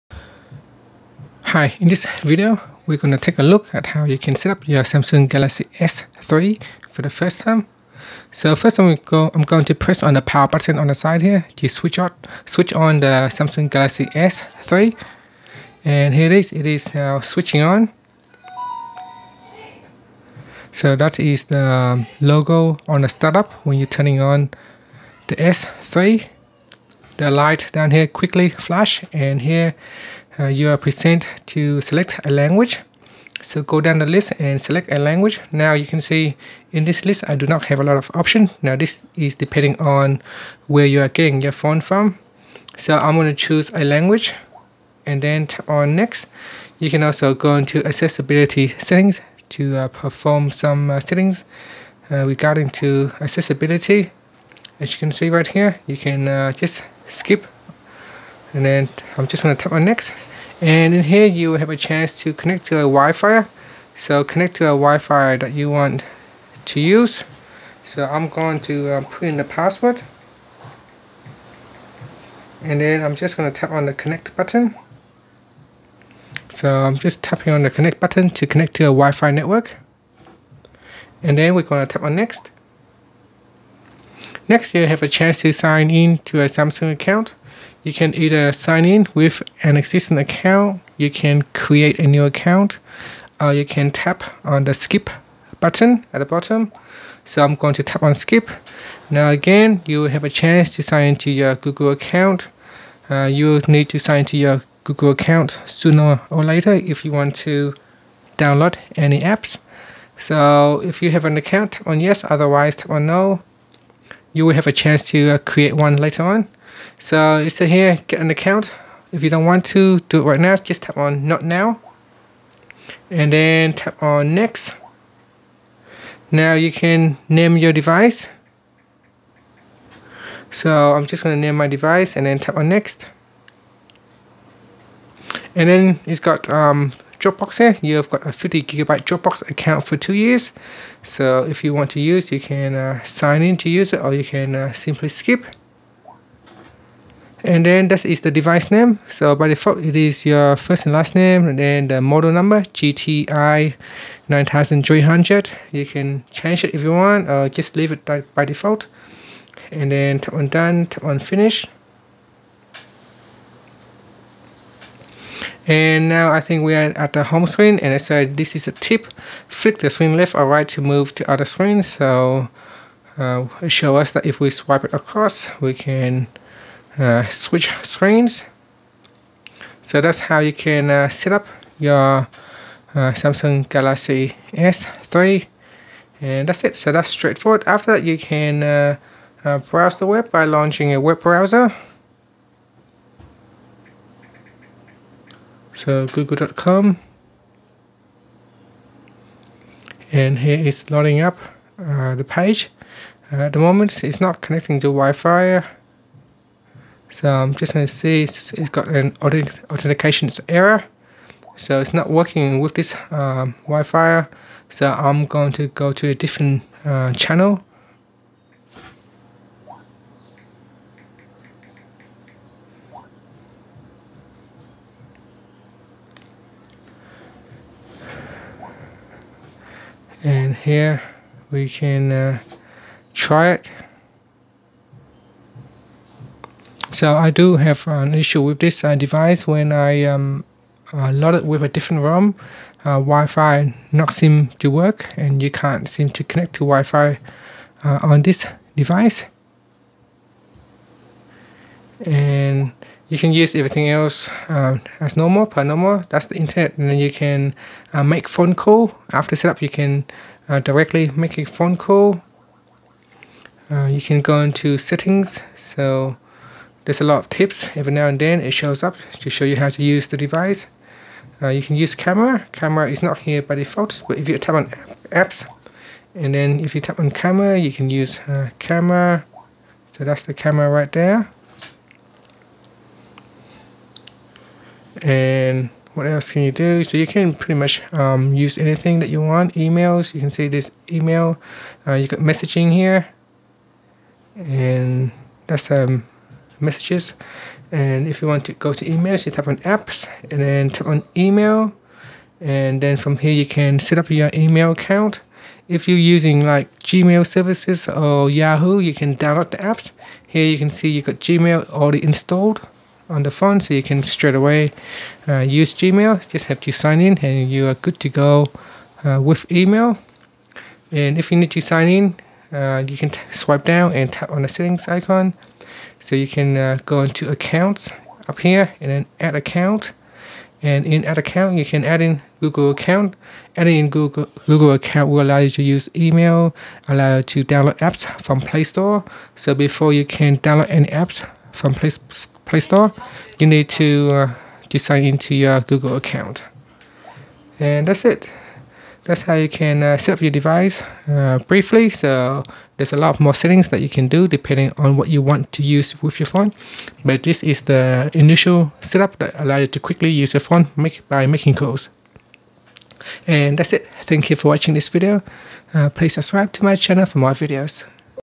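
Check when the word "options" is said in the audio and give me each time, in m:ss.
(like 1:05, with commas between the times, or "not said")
0:38.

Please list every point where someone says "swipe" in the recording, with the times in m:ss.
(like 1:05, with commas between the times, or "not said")
2:54, 5:23.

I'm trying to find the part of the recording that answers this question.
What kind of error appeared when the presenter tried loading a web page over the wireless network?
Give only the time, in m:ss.
3:29.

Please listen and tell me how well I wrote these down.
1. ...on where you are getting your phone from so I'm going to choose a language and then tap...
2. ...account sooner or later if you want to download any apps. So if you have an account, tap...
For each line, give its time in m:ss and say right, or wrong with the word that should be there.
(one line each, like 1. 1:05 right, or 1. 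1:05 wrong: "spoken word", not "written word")
1. 0:39 right
2. 1:45 right.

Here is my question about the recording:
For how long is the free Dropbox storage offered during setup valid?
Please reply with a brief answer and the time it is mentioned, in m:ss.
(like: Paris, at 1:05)
two years, at 2:19.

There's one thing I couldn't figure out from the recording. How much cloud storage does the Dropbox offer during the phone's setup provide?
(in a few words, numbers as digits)
50 gigabytes.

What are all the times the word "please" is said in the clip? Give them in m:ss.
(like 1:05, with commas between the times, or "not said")
6:05.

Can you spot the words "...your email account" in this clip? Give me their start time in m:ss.
5:04.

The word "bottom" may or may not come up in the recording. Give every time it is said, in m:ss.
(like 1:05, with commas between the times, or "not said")
1:36.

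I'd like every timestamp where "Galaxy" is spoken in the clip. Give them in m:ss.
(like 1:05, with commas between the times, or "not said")
0:05, 0:13, 3:03.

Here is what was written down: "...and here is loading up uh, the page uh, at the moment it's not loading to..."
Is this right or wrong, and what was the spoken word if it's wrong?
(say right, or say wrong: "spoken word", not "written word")
wrong: "connecting", not "loading".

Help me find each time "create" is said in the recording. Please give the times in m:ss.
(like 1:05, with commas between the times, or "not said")
1:31, 1:55.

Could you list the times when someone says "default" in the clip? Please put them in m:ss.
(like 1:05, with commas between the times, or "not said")
2:29, 2:38, 4:33.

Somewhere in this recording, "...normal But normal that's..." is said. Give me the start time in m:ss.
4:15.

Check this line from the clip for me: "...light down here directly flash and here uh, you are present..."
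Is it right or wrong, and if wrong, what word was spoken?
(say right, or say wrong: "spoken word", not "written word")
wrong: "quickly", not "directly".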